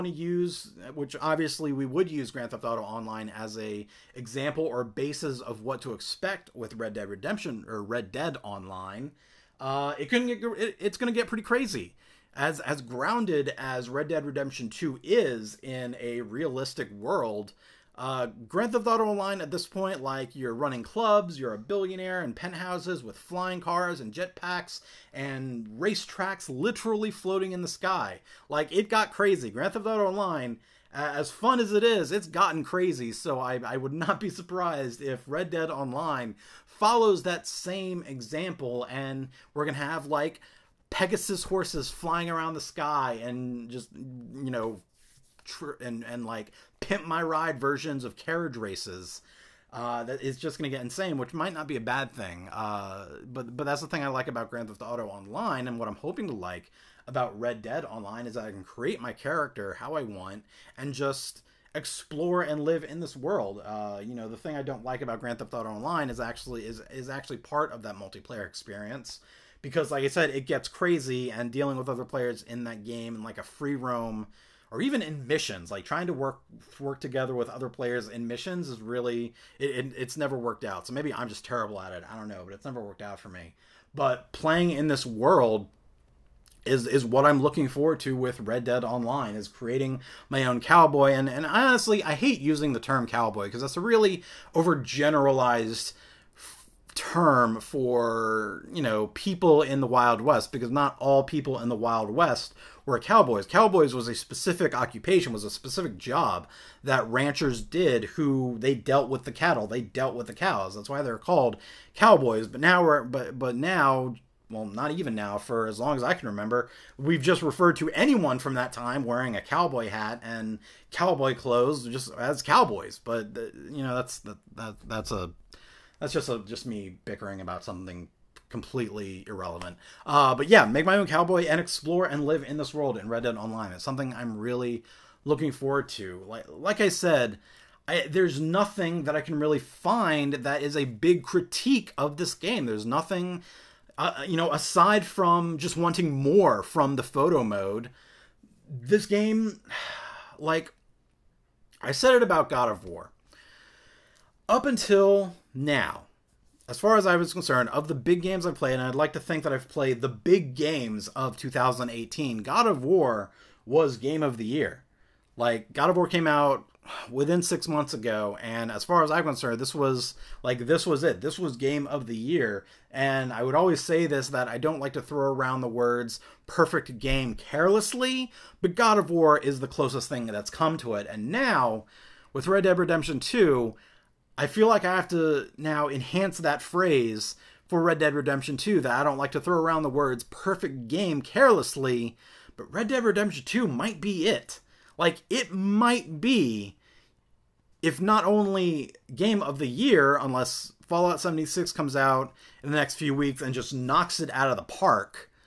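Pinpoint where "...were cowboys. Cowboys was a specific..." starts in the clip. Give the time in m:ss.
1:42.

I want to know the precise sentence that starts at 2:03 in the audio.
But you know, that's that, that that's a that's just a, just me bickering about something completely irrelevant.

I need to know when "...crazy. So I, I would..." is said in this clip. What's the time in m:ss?
0:32.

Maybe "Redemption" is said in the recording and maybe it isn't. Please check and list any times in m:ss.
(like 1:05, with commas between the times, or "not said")
0:07, 0:14, 3:02, 3:08, 3:13.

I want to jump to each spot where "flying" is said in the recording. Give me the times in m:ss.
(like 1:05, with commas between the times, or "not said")
0:23, 0:41.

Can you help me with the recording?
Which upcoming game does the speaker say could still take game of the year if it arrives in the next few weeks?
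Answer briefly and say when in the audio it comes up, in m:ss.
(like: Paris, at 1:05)
Fallout 76, at 3:20.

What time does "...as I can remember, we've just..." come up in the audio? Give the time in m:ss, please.
1:55.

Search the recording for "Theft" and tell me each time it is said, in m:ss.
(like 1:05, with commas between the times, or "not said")
0:02, 0:18, 0:29, 0:54, 1:05.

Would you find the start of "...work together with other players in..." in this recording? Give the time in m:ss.
1:16.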